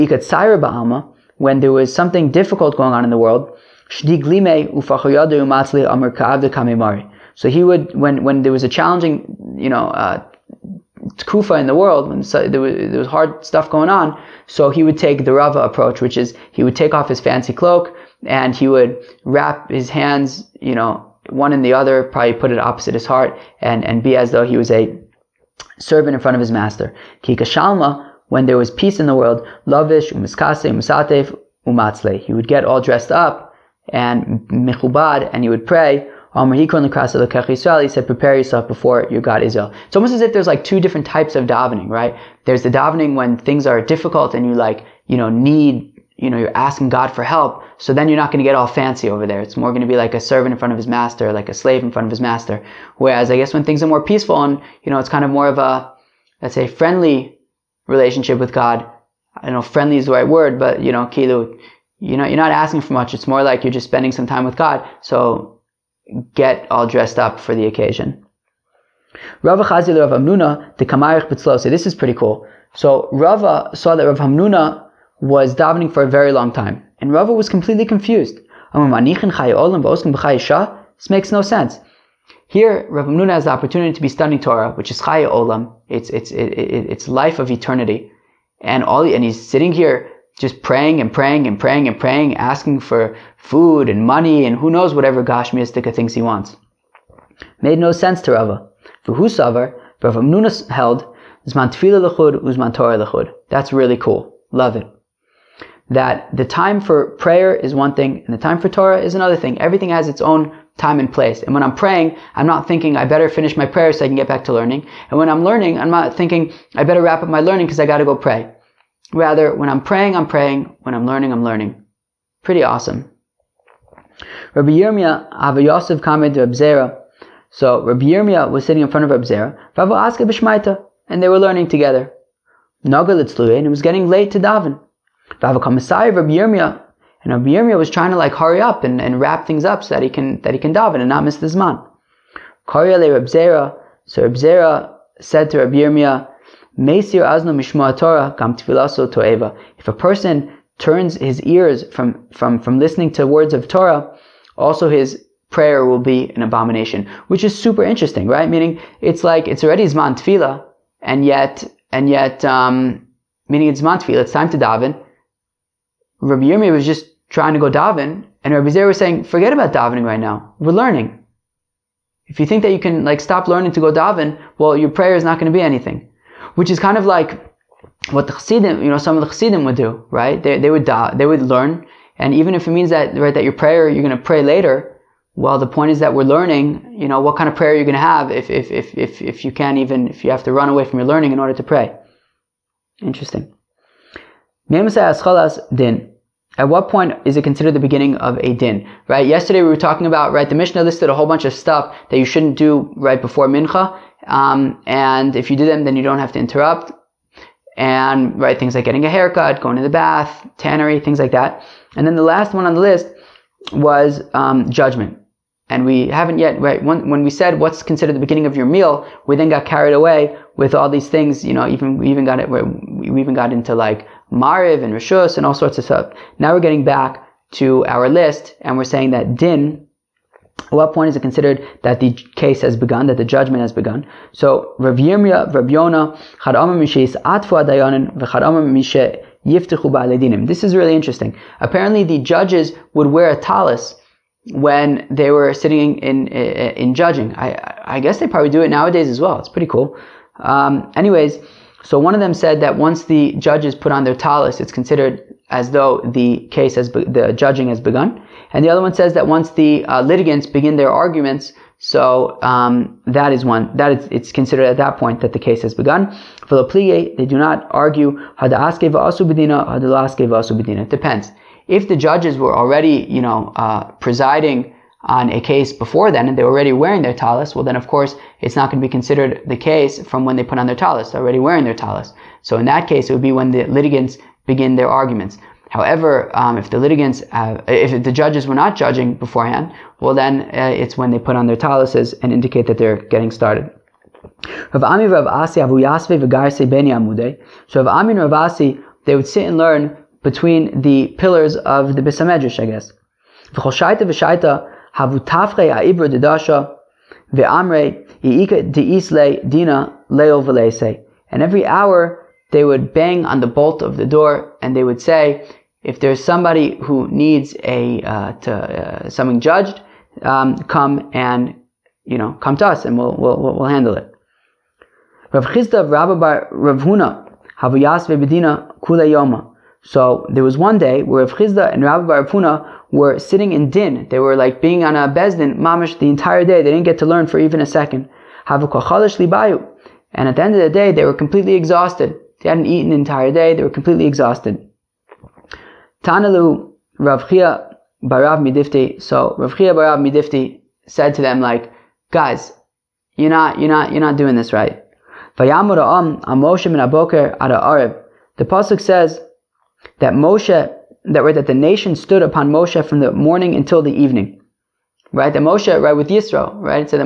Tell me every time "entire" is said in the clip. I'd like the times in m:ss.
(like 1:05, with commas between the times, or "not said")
5:36, 5:42.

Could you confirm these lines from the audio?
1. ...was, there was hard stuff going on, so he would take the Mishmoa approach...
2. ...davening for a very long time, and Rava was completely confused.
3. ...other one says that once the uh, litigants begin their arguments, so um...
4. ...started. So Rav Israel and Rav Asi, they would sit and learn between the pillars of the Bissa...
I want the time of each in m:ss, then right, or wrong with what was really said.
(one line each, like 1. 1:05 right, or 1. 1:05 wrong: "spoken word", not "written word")
1. 0:12 wrong: "Rava", not "Mishmoa"
2. 1:15 right
3. 4:18 right
4. 4:53 wrong: "Ami", not "Israel".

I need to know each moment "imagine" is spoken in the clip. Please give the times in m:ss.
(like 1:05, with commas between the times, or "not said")
not said.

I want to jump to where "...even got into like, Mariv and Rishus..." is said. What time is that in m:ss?
3:43.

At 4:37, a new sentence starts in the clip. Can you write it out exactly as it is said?
well then of course it's not going to be considered the case from when they put on their talis.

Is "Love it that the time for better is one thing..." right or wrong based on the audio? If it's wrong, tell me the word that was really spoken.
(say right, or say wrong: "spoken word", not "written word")
wrong: "prayer", not "better".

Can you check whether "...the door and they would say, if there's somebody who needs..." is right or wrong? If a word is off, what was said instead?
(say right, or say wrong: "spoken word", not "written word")
right.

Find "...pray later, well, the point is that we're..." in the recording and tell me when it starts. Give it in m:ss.
3:04.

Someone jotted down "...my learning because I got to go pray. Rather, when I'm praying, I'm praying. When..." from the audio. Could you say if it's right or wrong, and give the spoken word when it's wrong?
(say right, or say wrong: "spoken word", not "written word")
right.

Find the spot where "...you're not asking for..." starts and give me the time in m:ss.
1:02.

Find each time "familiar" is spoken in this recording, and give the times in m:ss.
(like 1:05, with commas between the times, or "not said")
not said.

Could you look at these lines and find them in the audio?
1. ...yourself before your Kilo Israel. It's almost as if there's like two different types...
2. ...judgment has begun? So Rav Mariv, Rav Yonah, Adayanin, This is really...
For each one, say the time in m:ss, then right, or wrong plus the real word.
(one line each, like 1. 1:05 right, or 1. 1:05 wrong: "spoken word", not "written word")
1. 0:38 wrong: "God", not "Kilo"
2. 3:53 wrong: "Yirmiyah", not "Mariv".